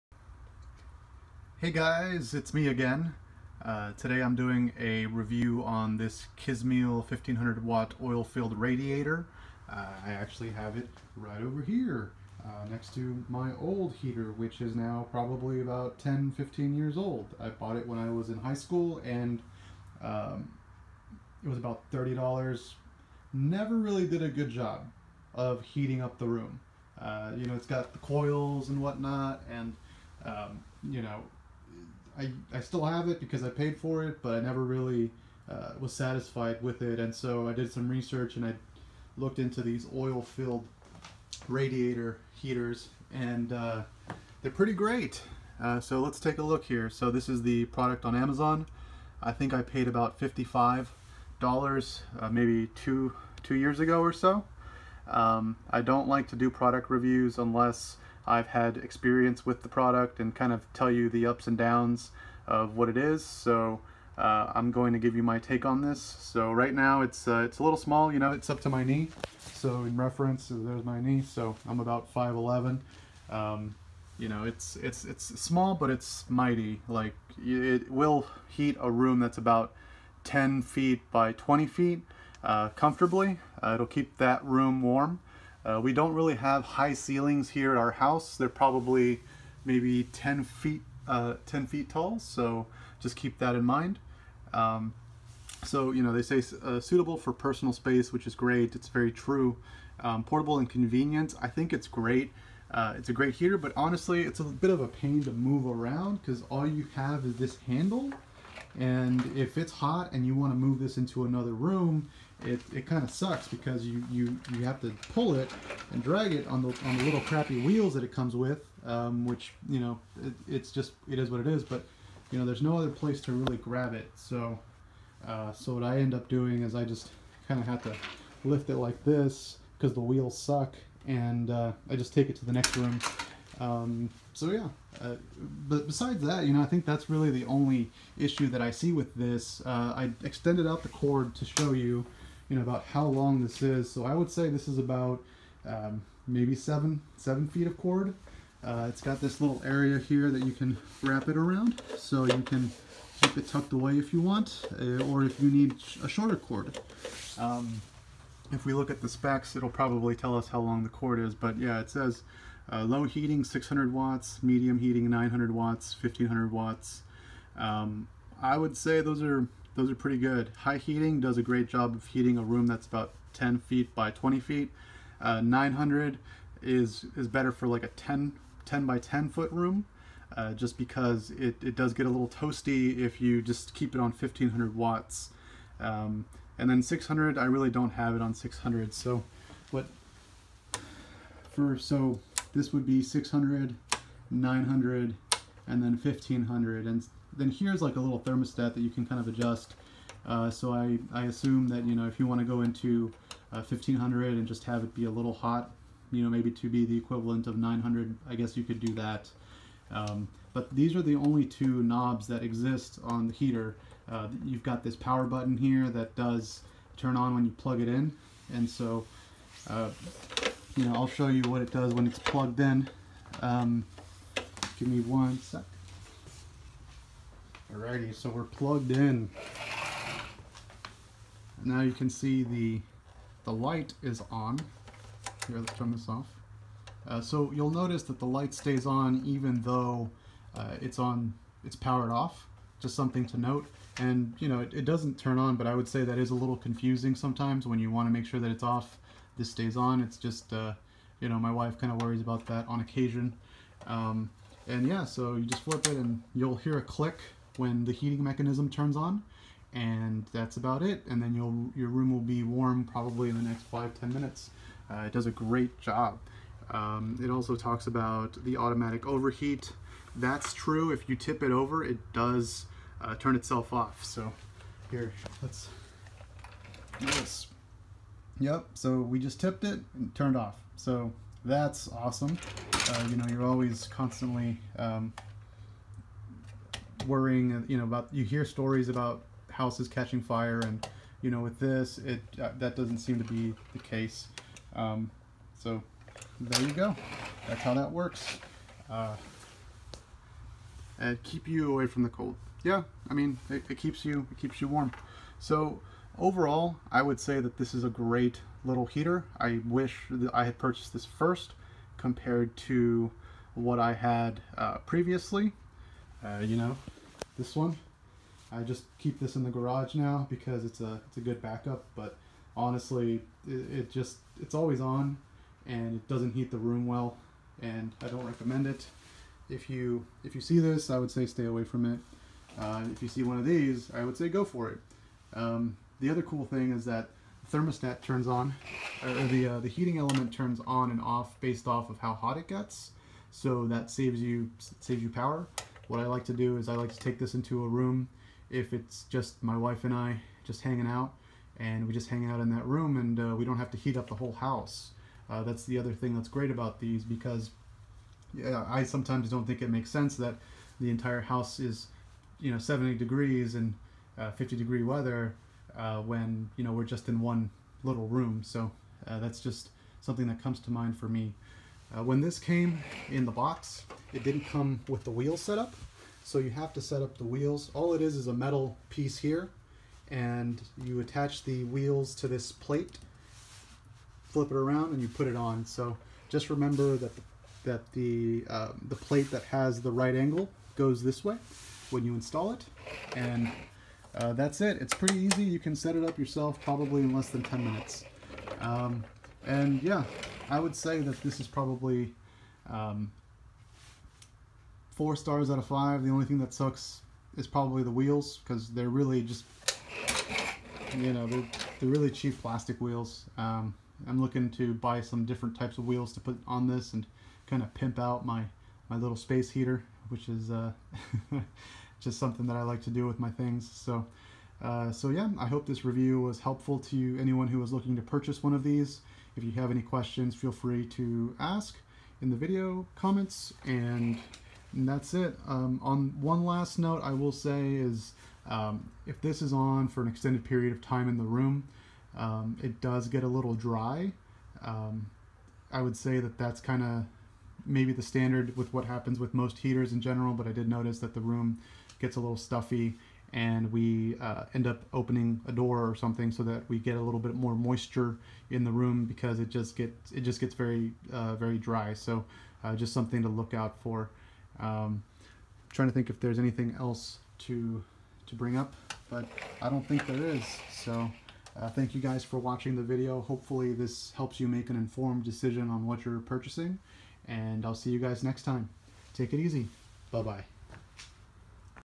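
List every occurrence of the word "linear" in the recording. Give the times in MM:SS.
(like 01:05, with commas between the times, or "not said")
not said.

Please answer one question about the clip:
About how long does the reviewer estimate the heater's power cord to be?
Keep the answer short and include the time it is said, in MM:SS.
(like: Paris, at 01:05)
7 feet, at 02:27.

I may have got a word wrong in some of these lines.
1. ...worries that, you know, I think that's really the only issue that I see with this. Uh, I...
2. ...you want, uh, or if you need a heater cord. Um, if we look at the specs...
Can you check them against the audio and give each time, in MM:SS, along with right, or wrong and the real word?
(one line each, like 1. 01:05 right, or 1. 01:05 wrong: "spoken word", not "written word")
1. 02:15 wrong: "besides", not "worries"
2. 02:34 wrong: "shorter", not "heater".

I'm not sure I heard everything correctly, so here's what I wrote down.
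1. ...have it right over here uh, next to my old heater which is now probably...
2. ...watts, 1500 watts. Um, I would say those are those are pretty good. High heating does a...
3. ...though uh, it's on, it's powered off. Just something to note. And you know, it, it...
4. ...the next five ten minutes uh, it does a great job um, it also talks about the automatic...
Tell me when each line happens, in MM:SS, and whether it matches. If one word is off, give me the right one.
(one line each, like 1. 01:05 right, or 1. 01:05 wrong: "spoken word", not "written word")
1. 00:10 right
2. 02:45 right
3. 03:59 right
4. 04:23 right.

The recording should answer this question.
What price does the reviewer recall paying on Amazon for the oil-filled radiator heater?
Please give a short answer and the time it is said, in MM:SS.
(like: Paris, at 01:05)
$55, at 00:50.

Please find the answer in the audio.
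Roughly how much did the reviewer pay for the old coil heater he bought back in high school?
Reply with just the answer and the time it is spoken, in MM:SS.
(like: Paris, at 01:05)
$30, at 00:21.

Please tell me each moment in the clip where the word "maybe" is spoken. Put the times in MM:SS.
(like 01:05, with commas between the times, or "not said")
00:52, 01:29, 02:26, 03:26, 07:27.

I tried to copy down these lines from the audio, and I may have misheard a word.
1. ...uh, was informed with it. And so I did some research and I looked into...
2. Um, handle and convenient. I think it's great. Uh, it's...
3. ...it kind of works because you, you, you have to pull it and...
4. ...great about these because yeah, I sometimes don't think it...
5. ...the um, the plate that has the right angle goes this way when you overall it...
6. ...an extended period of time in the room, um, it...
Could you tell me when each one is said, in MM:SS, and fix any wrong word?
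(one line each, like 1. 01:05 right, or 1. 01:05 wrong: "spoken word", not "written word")
1. 00:35 wrong: "satisfied", not "informed"
2. 01:39 wrong: "portable", not "handle"
3. 01:52 wrong: "sucks", not "works"
4. 05:56 right
5. 06:27 wrong: "install", not "overall"
6. 07:20 right.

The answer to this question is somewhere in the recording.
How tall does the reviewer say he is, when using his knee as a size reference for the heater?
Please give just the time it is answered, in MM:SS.
01:12.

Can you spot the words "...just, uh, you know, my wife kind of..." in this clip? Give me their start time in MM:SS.
04:10.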